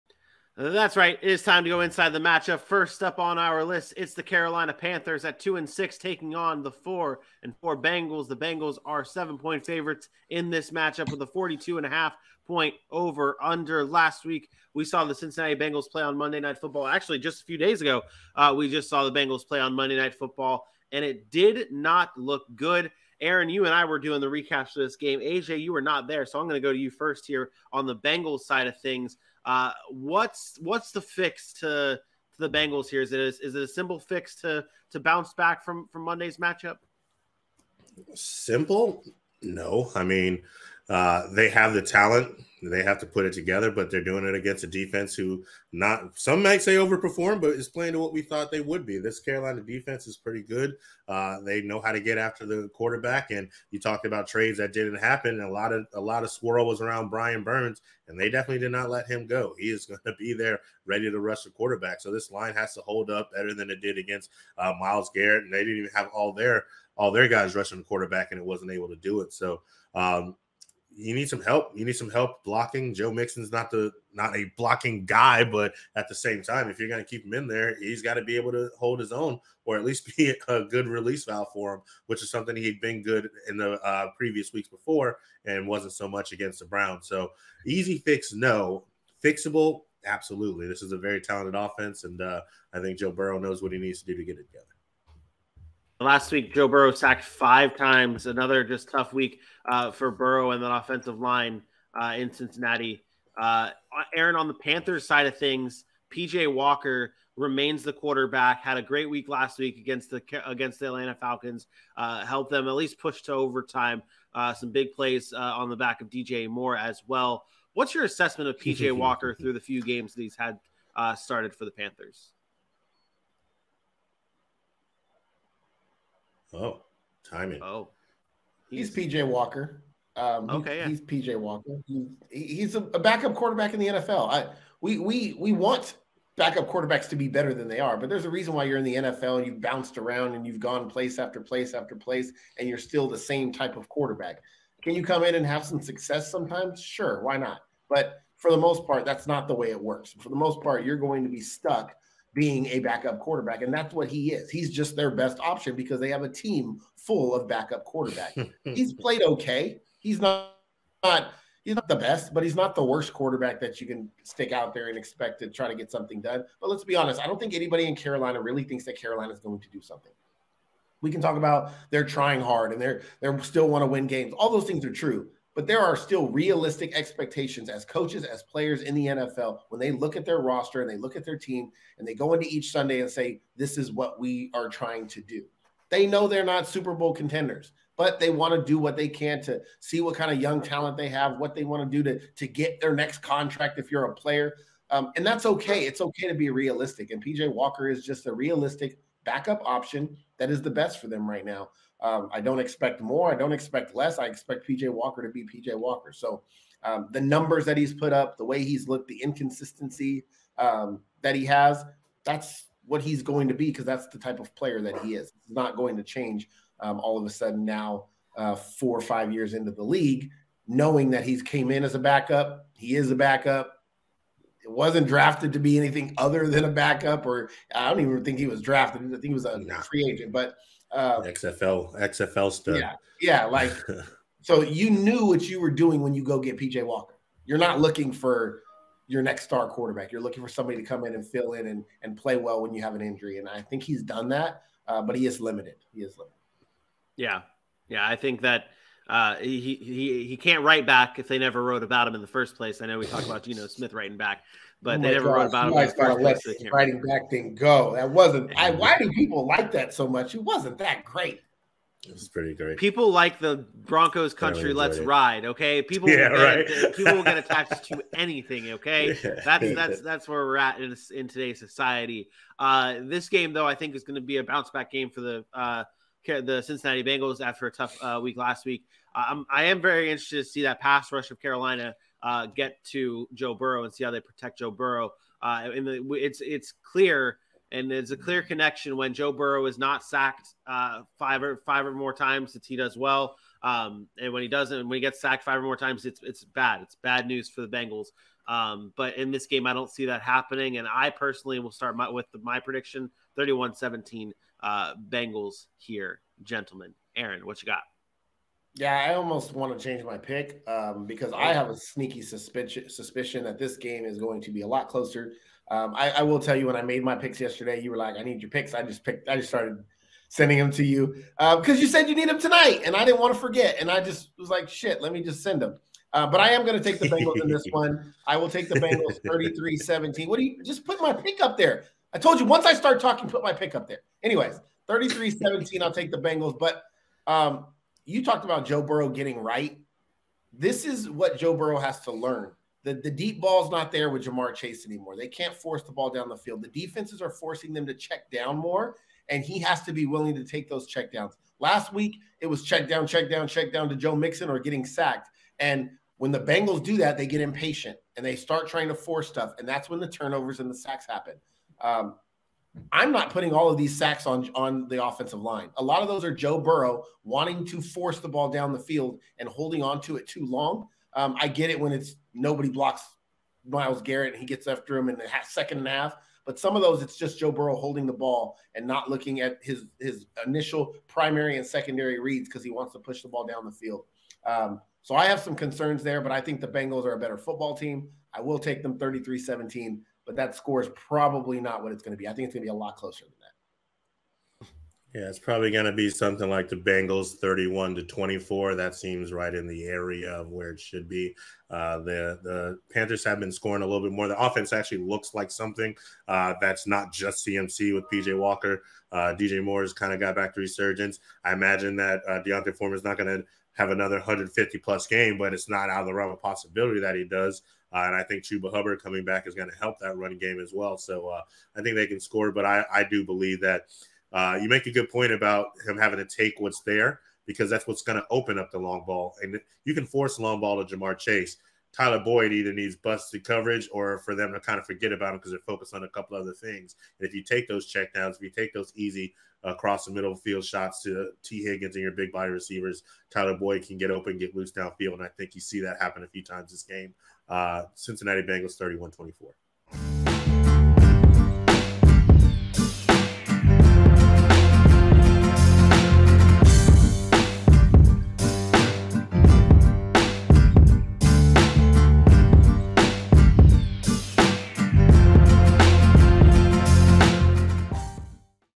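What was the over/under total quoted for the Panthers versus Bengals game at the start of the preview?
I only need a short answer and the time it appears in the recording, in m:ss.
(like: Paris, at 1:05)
42.5, at 0:11.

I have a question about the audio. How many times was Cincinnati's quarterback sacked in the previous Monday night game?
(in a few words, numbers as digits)
5.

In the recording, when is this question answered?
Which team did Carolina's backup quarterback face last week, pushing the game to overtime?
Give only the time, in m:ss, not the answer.
1:50.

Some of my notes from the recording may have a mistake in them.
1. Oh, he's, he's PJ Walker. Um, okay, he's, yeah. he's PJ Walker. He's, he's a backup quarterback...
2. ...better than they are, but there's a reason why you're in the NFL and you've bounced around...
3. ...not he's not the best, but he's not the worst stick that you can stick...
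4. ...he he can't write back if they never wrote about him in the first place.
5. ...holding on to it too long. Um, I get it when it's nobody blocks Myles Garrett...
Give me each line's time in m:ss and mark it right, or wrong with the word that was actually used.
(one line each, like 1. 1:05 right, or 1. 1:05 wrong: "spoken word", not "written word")
1. 2:07 right
2. 2:17 right
3. 2:41 wrong: "quarterback", not "stick"
4. 4:09 right
5. 6:09 right.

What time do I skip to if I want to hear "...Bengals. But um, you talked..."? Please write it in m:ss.
5:36.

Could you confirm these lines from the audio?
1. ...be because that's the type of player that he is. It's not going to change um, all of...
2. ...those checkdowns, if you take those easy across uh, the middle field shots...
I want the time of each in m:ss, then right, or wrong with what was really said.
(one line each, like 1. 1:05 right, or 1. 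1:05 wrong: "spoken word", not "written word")
1. 3:33 right
2. 7:17 right.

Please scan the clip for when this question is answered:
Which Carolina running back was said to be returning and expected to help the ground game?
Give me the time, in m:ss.
6:58.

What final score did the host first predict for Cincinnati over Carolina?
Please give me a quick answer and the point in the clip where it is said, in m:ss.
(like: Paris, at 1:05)
31-17, at 5:03.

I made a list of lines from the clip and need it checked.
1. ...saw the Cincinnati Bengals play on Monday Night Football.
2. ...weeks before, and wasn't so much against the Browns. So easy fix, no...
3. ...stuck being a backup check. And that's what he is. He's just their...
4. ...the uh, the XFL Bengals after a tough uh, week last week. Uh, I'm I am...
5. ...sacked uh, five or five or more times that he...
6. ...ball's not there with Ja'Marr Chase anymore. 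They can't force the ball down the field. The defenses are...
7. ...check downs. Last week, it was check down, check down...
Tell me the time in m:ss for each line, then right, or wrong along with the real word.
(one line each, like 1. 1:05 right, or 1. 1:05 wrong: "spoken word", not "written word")
1. 0:14 right
2. 1:24 right
3. 2:31 wrong: "quarterback", not "check"
4. 4:35 wrong: "Cincinnati", not "XFL"
5. 4:50 right
6. 5:43 right
7. 5:50 right.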